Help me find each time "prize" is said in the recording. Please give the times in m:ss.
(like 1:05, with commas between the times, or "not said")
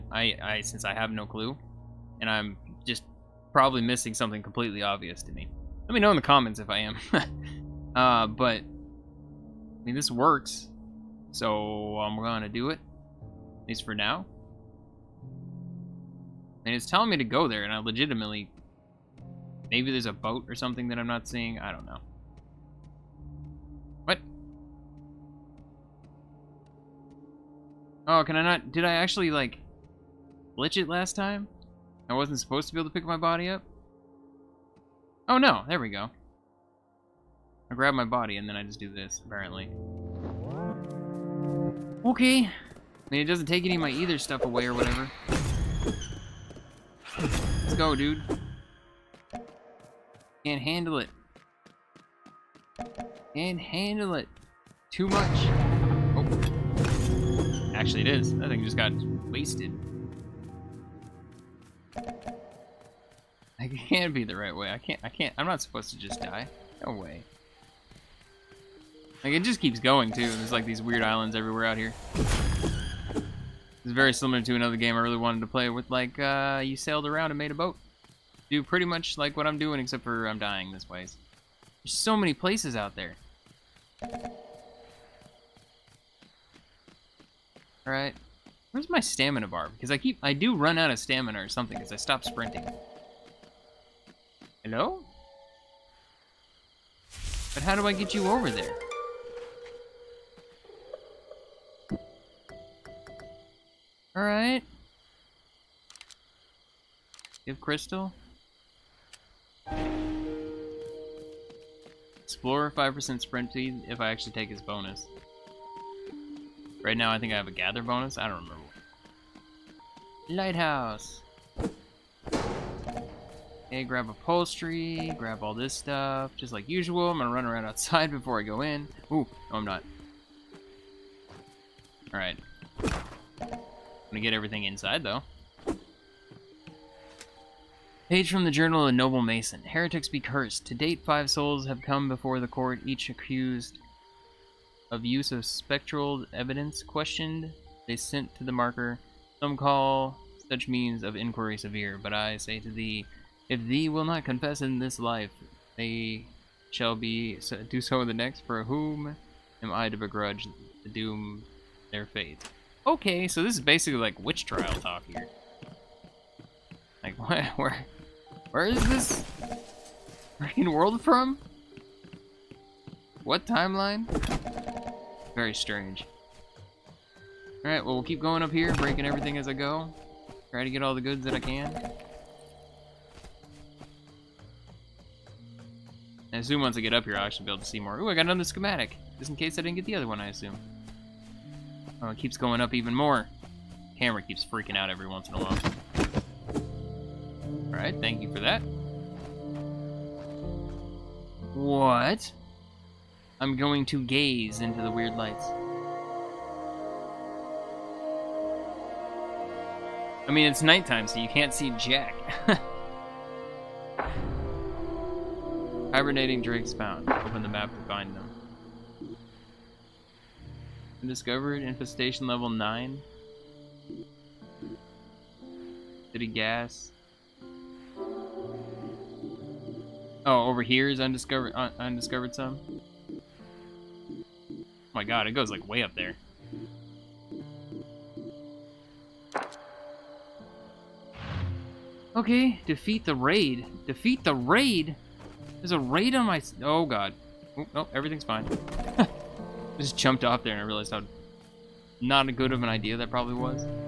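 not said.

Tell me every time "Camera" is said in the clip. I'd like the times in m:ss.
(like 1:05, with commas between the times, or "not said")
3:13.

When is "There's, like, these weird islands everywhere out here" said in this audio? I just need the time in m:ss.
1:10.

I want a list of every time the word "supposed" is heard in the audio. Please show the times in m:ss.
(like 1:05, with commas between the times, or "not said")
0:32, 1:05.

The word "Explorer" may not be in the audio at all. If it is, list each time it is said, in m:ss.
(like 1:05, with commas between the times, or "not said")
1:52.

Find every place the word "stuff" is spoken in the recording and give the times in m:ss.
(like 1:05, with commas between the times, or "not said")
0:44, 2:05.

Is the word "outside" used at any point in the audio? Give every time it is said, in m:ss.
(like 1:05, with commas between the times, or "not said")
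2:07.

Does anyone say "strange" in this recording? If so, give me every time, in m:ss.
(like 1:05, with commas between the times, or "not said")
2:55.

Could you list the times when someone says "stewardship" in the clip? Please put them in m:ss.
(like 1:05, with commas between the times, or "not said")
not said.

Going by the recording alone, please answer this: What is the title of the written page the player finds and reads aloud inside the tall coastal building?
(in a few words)
Page from the Journal of a Noble Mason.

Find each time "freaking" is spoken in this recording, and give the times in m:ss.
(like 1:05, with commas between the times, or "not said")
2:50, 3:14.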